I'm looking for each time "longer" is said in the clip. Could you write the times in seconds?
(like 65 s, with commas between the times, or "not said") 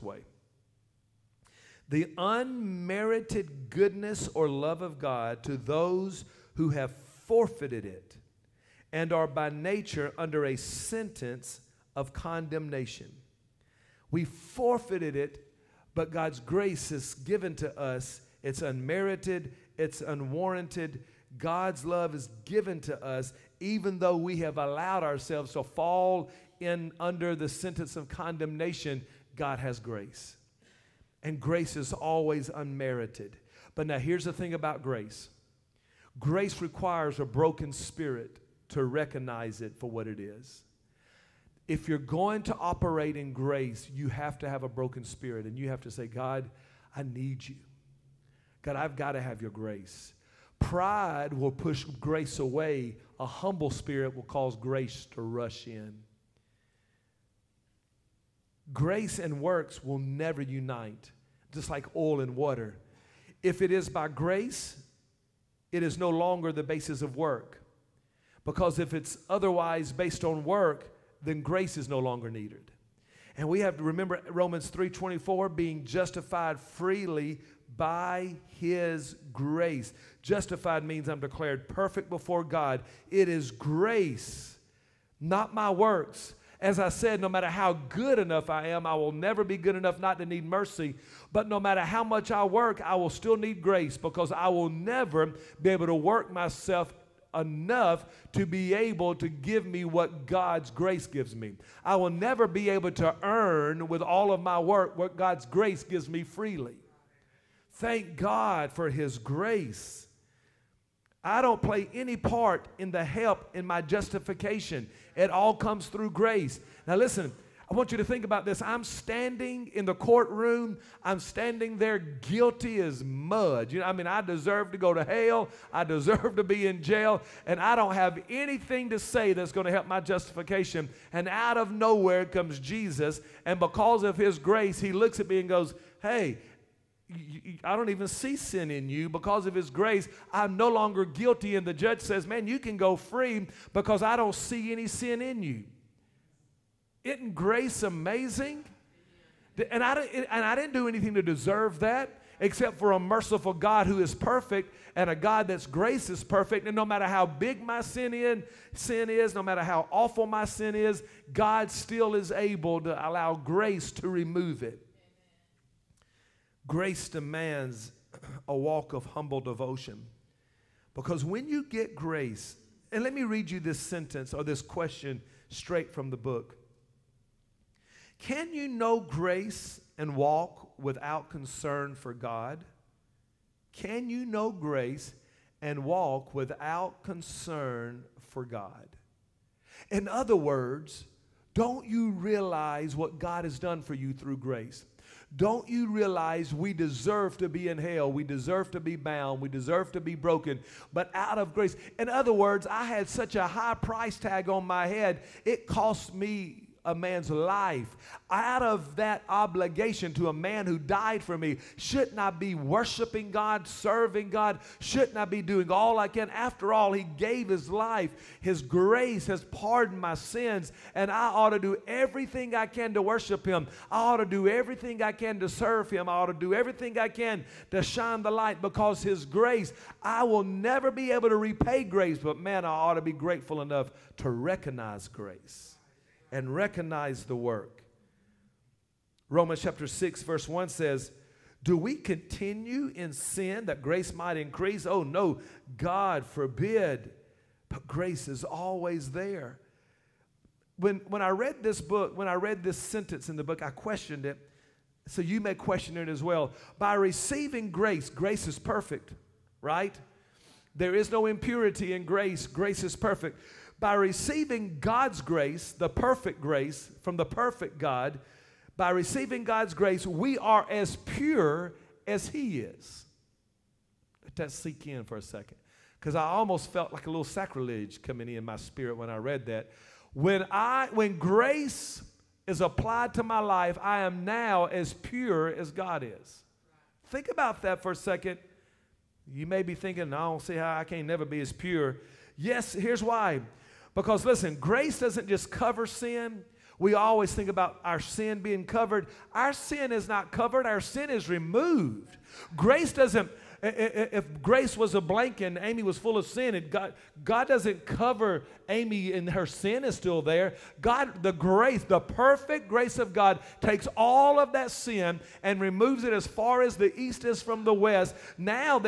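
66 s, 71 s, 140 s.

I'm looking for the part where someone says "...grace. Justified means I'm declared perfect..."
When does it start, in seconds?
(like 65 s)
79 s.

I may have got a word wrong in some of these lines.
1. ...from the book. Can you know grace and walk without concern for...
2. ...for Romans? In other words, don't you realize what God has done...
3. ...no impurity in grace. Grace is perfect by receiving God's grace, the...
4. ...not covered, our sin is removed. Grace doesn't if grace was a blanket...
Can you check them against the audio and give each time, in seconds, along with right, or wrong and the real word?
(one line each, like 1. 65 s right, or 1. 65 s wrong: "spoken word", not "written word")
1. 175 s right
2. 188 s wrong: "God", not "Romans"
3. 261 s right
4. 300 s right.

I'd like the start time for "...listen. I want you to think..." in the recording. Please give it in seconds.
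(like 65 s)
116 s.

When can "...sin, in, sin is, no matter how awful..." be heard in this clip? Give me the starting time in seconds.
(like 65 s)
157 s.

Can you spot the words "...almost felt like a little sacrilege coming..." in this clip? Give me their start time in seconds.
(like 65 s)
276 s.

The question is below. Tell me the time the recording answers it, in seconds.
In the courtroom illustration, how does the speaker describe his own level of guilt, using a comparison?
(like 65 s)
121 s.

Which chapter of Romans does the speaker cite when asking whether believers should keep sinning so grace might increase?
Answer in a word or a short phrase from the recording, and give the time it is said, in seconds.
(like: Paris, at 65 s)
Romans chapter 6, at 239 s.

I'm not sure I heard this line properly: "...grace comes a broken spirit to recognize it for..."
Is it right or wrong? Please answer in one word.
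wrong.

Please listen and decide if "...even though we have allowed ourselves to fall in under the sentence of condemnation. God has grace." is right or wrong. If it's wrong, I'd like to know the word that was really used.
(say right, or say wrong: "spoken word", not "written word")
right.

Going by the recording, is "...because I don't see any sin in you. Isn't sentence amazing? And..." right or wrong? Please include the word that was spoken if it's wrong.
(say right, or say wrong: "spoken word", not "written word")
wrong: "grace", not "sentence".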